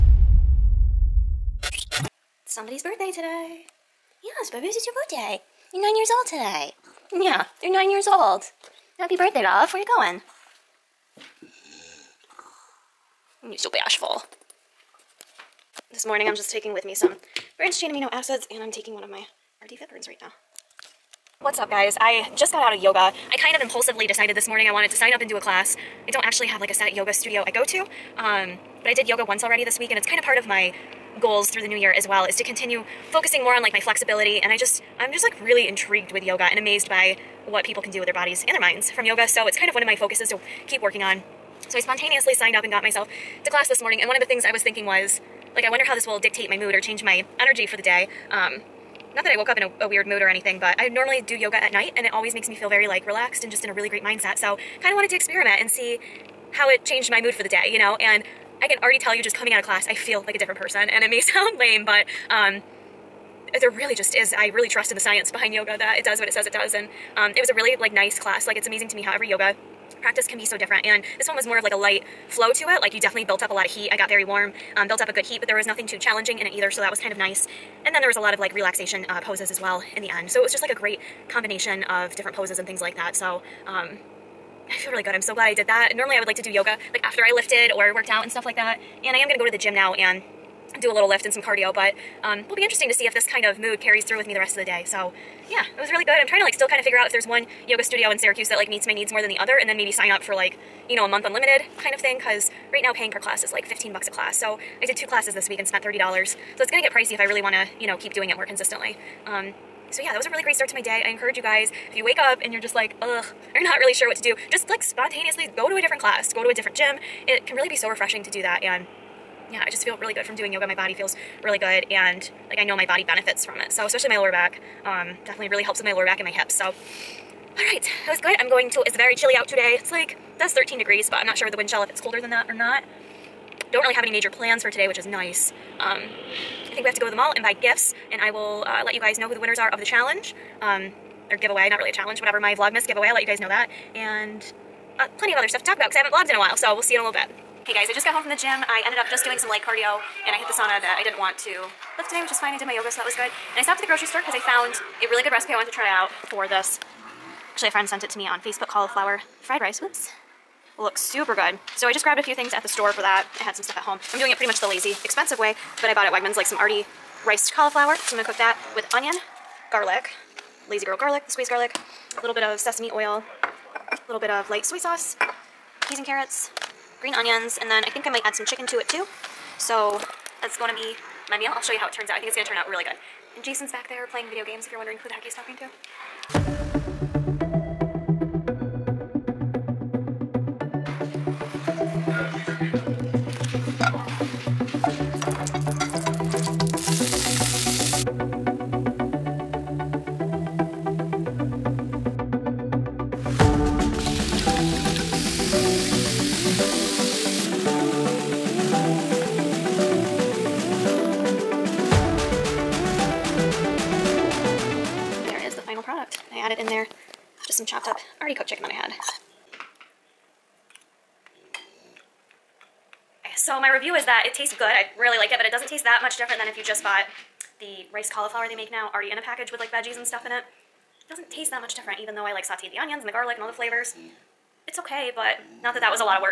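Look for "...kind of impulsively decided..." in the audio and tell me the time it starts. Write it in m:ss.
0:23.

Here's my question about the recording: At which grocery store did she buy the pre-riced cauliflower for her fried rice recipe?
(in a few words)
Wegmans.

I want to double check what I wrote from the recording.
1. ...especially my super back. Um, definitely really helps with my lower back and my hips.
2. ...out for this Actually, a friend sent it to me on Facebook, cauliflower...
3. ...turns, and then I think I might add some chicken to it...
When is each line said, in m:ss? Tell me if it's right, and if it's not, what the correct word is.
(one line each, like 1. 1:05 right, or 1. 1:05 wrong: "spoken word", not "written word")
1. 2:03 wrong: "lower", not "super"
2. 2:35 right
3. 2:57 wrong: "onions", not "turns".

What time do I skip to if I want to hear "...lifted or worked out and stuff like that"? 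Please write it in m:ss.
1:27.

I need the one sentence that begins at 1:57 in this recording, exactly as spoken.
It can really be so refreshing to do that.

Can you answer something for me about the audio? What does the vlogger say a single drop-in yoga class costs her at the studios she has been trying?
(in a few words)
$15.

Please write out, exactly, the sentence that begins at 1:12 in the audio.
Like you definitely built up a lot of heat.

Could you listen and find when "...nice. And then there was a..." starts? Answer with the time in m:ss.
1:17.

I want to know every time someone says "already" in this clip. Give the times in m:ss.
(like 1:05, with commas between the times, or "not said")
0:29, 0:58, 2:46, 3:38, 3:48.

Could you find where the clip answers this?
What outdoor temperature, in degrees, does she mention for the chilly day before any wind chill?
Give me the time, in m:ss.
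2:10.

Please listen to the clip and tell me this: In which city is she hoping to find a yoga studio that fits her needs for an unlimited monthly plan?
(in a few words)
Syracuse.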